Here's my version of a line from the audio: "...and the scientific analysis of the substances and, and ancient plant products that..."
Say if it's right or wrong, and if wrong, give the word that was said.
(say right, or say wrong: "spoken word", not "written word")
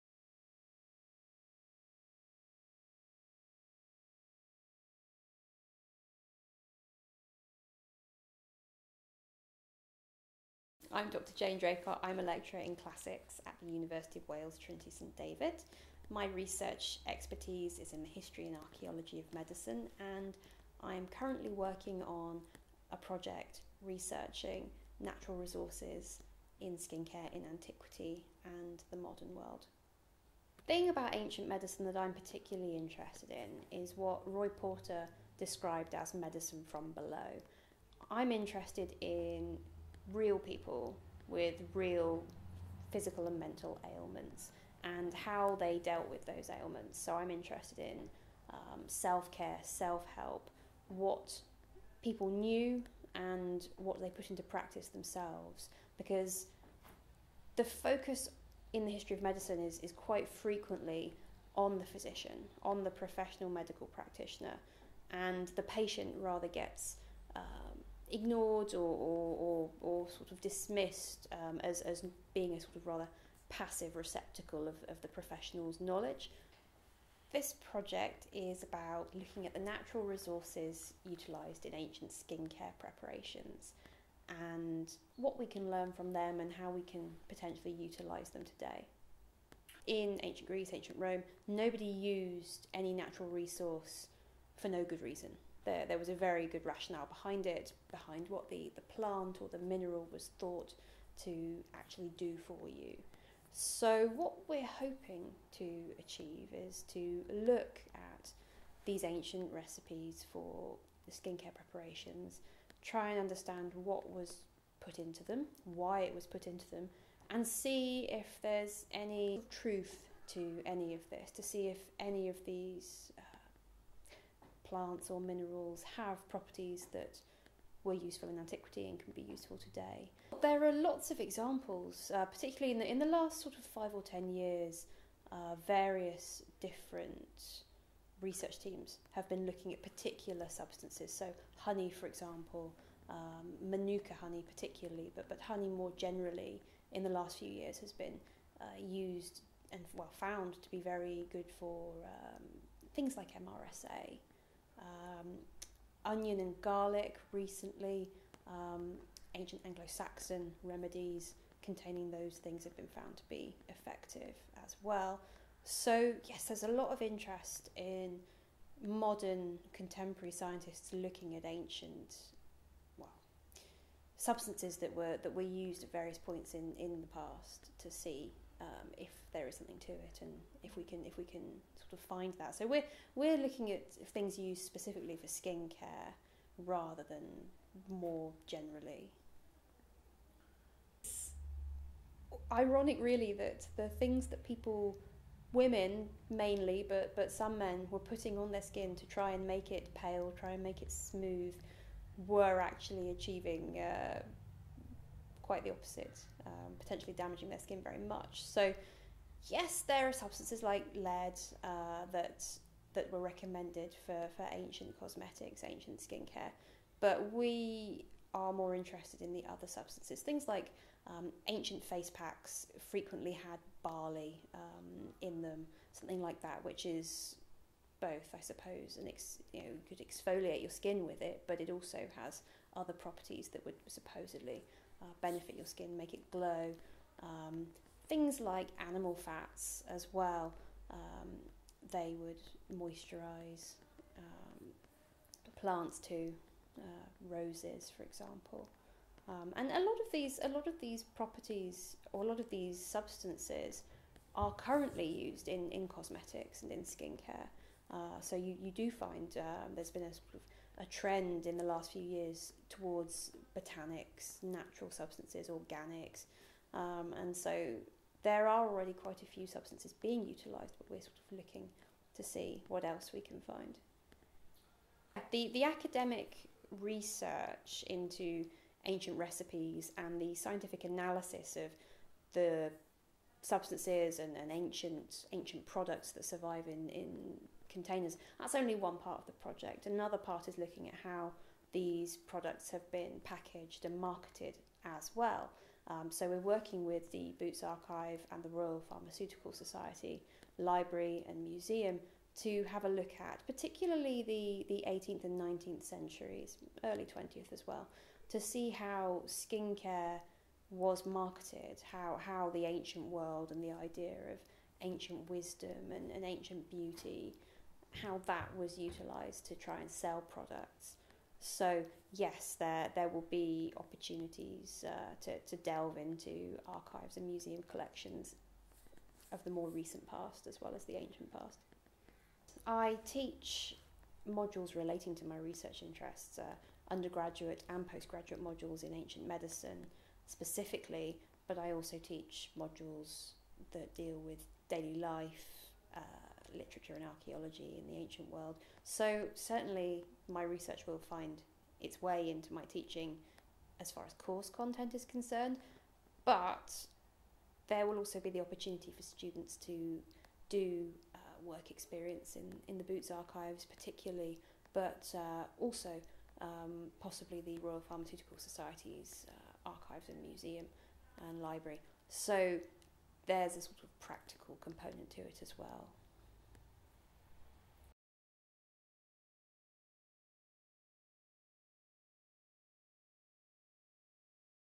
wrong: "ancient", not "plant".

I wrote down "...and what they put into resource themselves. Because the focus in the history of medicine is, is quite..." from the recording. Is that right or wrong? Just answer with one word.
wrong.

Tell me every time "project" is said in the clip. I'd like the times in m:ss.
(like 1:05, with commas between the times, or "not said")
0:22, 1:17, 4:49.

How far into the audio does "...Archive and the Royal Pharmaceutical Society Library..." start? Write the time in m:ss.
4:57.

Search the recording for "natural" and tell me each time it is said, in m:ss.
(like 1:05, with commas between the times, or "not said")
0:24, 1:19, 1:32, 4:24.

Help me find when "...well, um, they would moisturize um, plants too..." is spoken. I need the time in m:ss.
4:00.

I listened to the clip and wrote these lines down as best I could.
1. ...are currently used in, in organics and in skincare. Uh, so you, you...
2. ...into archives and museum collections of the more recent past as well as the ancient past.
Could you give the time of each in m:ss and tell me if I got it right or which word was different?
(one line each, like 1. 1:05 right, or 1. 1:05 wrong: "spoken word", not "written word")
1. 4:14 wrong: "cosmetics", not "organics"
2. 5:25 right.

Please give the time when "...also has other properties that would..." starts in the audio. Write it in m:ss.
3:51.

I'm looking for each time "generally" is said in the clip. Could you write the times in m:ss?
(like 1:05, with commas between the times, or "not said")
2:25, 3:08.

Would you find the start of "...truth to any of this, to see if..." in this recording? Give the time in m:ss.
1:59.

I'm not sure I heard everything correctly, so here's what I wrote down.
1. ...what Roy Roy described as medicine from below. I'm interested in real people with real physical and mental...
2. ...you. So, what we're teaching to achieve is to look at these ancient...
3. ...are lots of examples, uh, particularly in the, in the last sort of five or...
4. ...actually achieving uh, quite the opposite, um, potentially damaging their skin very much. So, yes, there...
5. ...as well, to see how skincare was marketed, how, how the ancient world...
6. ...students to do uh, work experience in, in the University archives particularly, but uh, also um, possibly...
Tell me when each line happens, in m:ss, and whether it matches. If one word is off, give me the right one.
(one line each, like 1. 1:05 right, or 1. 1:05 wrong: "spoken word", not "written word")
1. 0:33 wrong: "Porter", not "Roy"
2. 1:42 wrong: "hoping", not "teaching"
3. 2:10 right
4. 3:22 right
5. 5:07 right
6. 5:59 wrong: "Boots", not "University".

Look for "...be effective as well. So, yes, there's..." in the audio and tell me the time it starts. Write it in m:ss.
2:43.